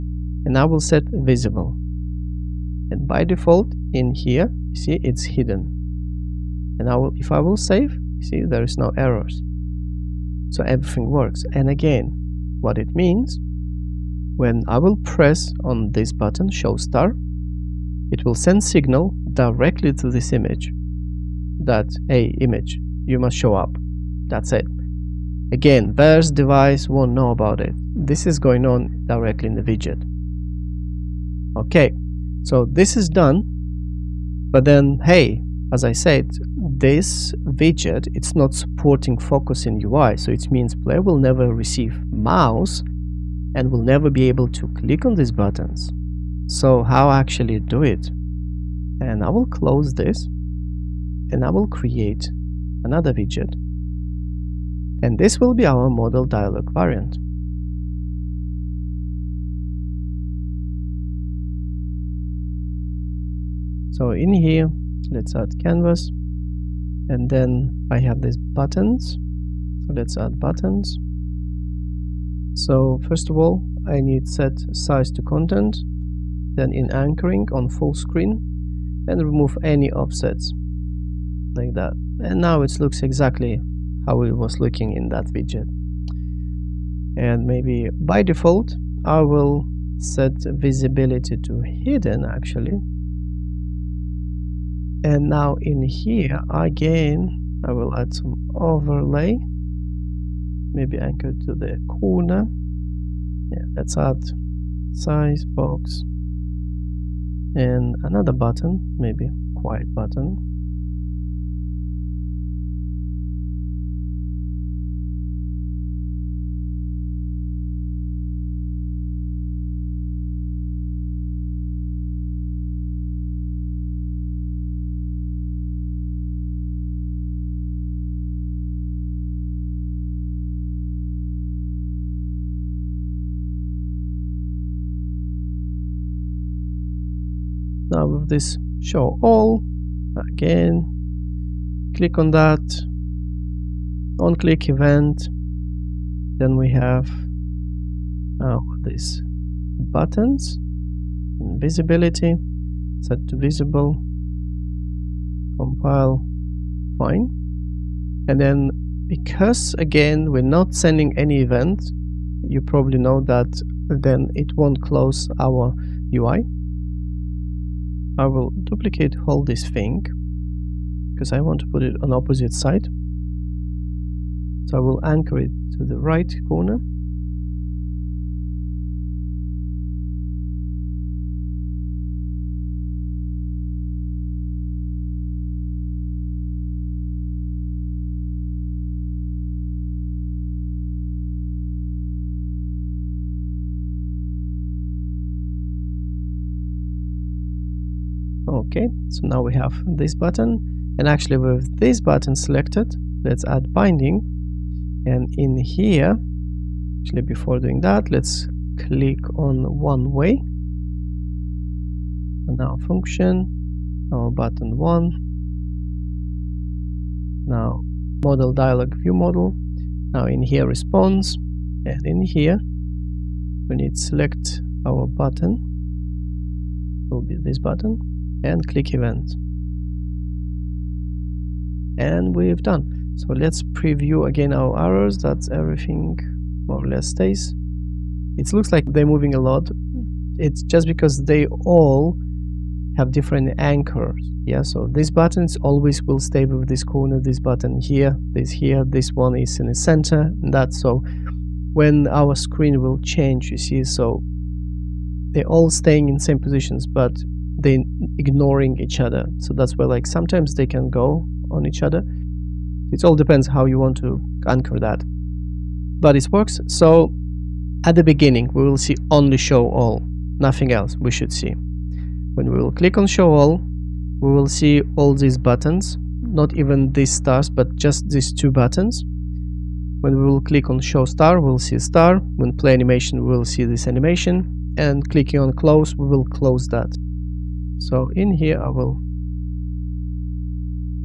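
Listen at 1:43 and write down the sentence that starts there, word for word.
Yeah, let's add size box and another button, maybe quiet button.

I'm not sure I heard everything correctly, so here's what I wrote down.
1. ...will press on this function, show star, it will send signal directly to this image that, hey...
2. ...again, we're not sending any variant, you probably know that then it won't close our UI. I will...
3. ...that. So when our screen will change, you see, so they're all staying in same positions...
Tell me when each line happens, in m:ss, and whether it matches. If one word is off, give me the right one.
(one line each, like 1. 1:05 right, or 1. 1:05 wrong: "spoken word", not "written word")
1. 0:14 wrong: "button", not "function"
2. 2:39 wrong: "event", not "variant"
3. 4:10 right.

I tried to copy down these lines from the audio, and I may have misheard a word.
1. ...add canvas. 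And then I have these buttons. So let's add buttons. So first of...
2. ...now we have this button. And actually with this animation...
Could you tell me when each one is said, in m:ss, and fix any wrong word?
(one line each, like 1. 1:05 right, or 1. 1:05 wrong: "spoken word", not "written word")
1. 1:05 right
2. 3:19 wrong: "button", not "animation".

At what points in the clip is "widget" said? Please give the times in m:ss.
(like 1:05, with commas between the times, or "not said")
0:29, 0:37, 0:53, 1:25.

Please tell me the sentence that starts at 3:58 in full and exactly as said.
It looks like they're moving a lot.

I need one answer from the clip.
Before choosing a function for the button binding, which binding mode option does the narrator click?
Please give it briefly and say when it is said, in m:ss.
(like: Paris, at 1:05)
one way, at 3:29.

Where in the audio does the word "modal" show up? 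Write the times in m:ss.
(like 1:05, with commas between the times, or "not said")
0:55, 3:38.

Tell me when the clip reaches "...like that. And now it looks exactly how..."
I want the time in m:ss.
1:21.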